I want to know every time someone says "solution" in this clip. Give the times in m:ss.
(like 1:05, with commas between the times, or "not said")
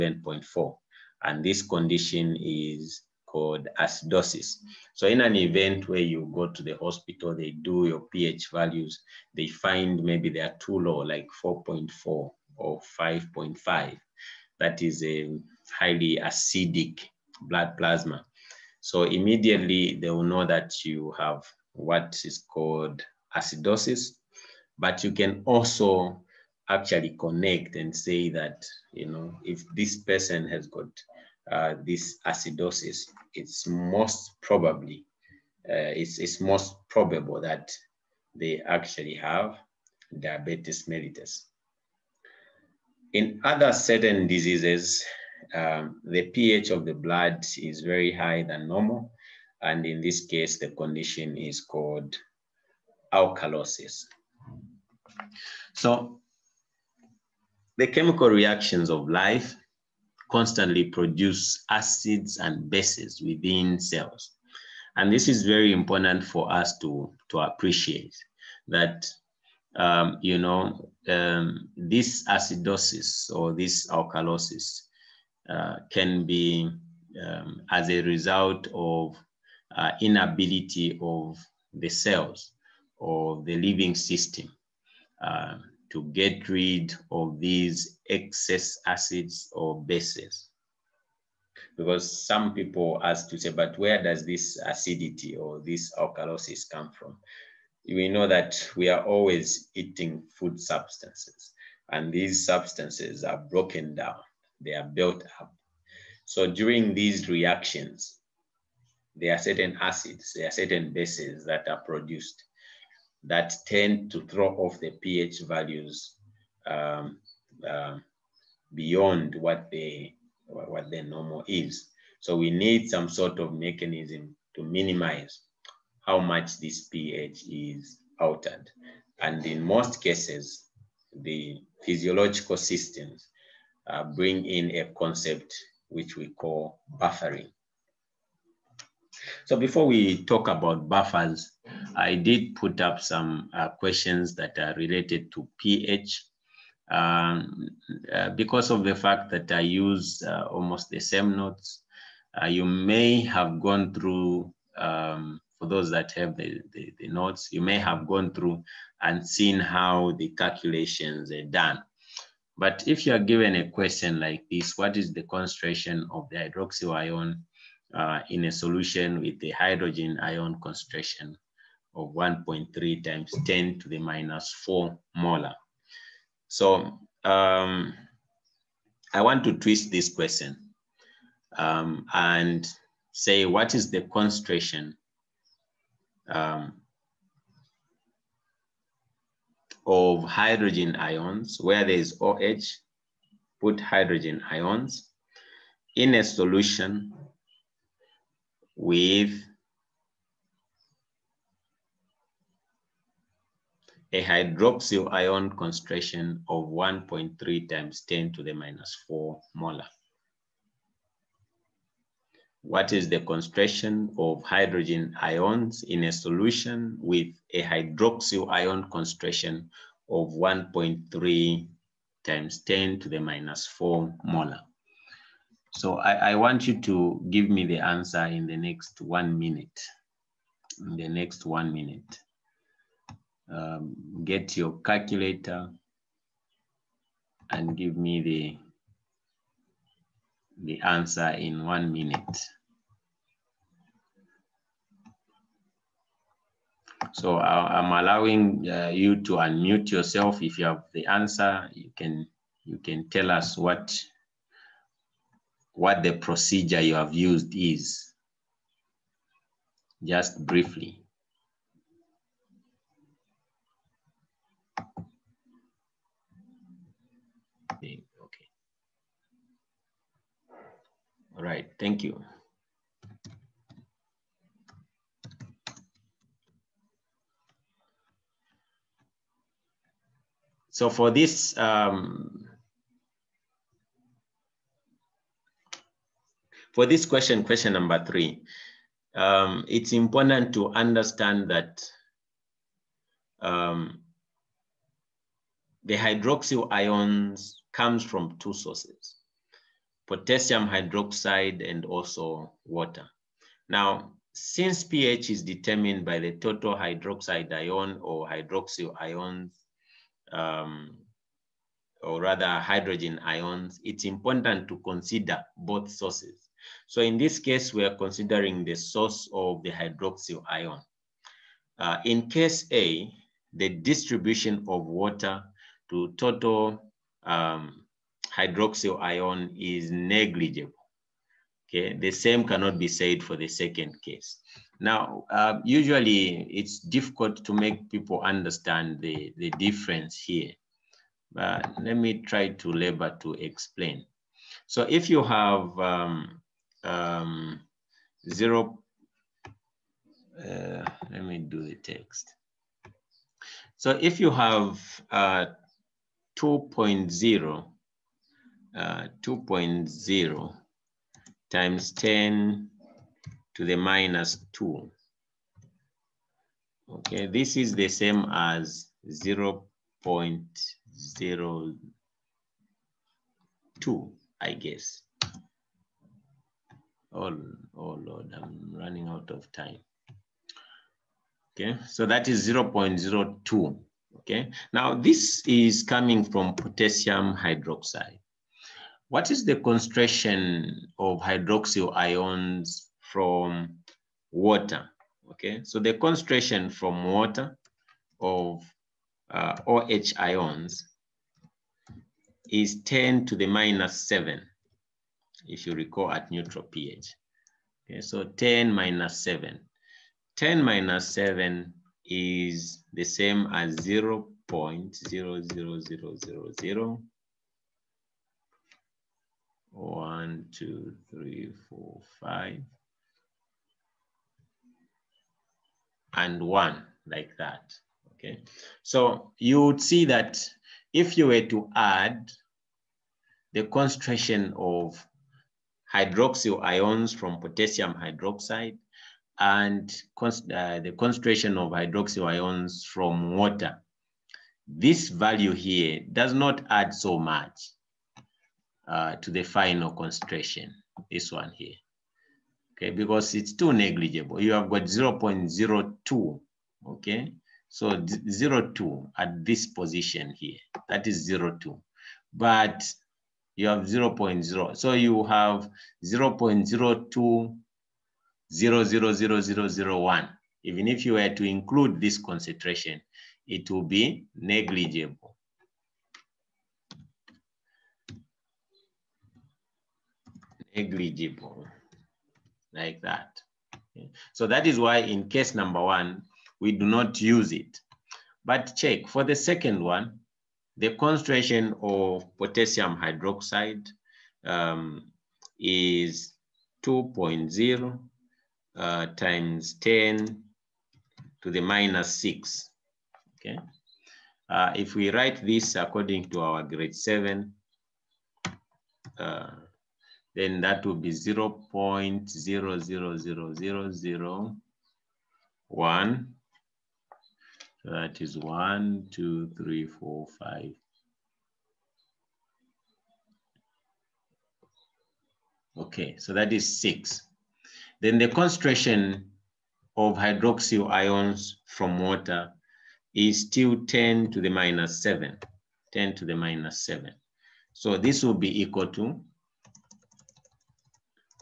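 2:48, 3:16, 3:36.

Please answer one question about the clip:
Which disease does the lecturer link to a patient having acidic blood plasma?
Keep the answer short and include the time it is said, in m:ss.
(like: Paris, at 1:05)
diabetes mellitus, at 0:40.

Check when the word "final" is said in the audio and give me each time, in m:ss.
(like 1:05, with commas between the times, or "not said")
7:29.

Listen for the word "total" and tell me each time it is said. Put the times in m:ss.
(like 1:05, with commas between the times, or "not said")
5:06, 5:26.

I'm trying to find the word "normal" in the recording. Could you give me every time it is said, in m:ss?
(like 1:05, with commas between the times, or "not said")
0:48, 2:01.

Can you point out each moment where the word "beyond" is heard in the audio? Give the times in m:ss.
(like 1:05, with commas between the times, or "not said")
1:58.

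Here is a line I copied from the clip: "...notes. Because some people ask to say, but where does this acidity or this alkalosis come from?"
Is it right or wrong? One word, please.
wrong.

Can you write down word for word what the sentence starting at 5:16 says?
So in this case, we are considering the source of the hydroxyl ion.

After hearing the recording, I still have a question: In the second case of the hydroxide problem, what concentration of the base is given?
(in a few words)
2.0 x 10^-6.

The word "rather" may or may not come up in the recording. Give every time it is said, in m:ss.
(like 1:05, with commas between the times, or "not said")
5:12.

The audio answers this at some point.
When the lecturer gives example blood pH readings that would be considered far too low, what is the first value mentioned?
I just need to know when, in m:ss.
0:11.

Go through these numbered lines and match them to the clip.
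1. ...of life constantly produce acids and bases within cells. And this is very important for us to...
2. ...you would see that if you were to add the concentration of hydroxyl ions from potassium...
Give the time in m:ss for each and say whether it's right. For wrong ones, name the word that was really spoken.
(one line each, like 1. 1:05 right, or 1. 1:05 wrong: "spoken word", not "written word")
1. 0:58 right
2. 7:09 right.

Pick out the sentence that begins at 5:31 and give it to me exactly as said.
Okay, the same cannot be said for the second case.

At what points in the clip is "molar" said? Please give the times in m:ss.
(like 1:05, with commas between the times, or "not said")
2:55, 3:29, 3:44.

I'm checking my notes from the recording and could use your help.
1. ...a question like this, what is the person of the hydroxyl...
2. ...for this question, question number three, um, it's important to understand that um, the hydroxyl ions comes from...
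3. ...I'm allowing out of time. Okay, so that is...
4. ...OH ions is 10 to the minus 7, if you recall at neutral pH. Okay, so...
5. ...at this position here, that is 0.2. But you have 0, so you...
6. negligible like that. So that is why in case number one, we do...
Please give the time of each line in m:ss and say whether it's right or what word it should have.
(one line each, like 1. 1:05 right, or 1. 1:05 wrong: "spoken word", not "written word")
1. 2:43 wrong: "concentration", not "person"
2. 4:46 right
3. 6:18 wrong: "running", not "allowing"
4. 6:39 right
5. 7:39 right
6. 8:00 right.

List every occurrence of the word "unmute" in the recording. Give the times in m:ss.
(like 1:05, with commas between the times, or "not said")
4:09.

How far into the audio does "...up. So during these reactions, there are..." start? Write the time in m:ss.
1:45.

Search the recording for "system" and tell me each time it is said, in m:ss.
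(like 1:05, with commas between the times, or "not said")
1:23, 2:12.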